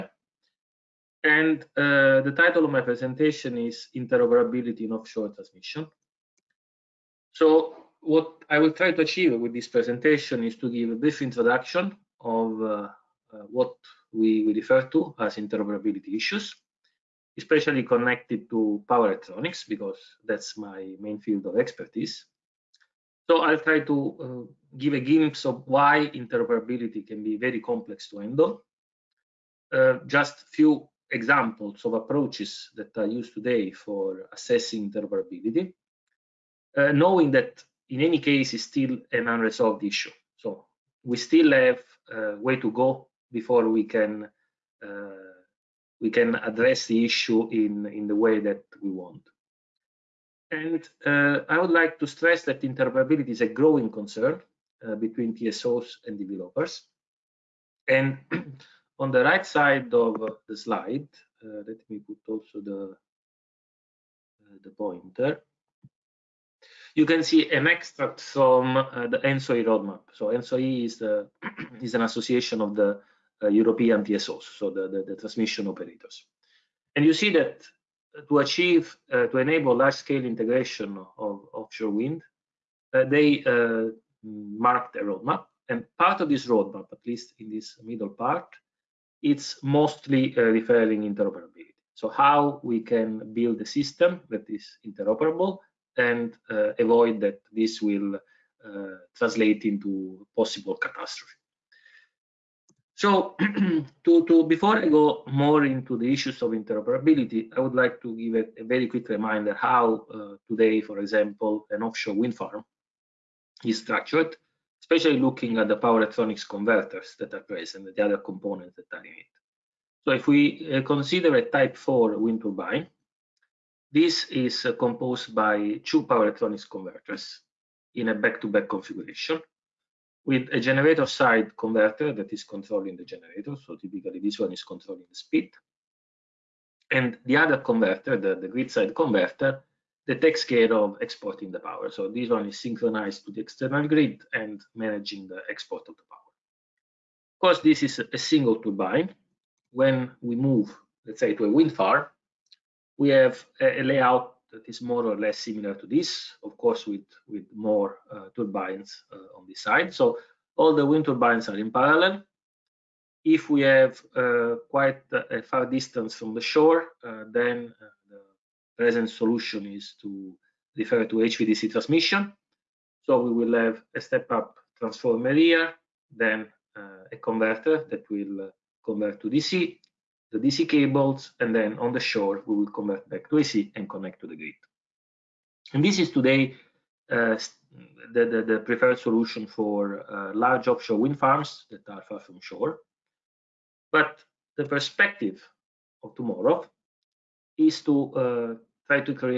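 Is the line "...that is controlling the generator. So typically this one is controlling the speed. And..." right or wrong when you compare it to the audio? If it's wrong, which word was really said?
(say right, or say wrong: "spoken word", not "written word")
right.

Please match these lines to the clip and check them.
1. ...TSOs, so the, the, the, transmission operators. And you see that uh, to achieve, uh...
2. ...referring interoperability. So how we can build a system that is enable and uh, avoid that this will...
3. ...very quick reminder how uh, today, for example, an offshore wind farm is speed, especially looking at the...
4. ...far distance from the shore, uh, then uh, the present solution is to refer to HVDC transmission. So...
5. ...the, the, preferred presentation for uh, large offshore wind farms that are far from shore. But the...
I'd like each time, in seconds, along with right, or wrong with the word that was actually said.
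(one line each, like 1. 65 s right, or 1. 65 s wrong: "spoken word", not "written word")
1. 74 s right
2. 90 s wrong: "interoperable", not "enable"
3. 108 s wrong: "structured", not "speed"
4. 165 s right
5. 188 s wrong: "solution", not "presentation".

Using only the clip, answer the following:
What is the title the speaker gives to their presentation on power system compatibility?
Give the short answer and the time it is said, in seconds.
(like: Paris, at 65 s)
Interoperability in Offshore Transmission, at 3 s.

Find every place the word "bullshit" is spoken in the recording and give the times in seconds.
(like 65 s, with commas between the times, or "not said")
not said.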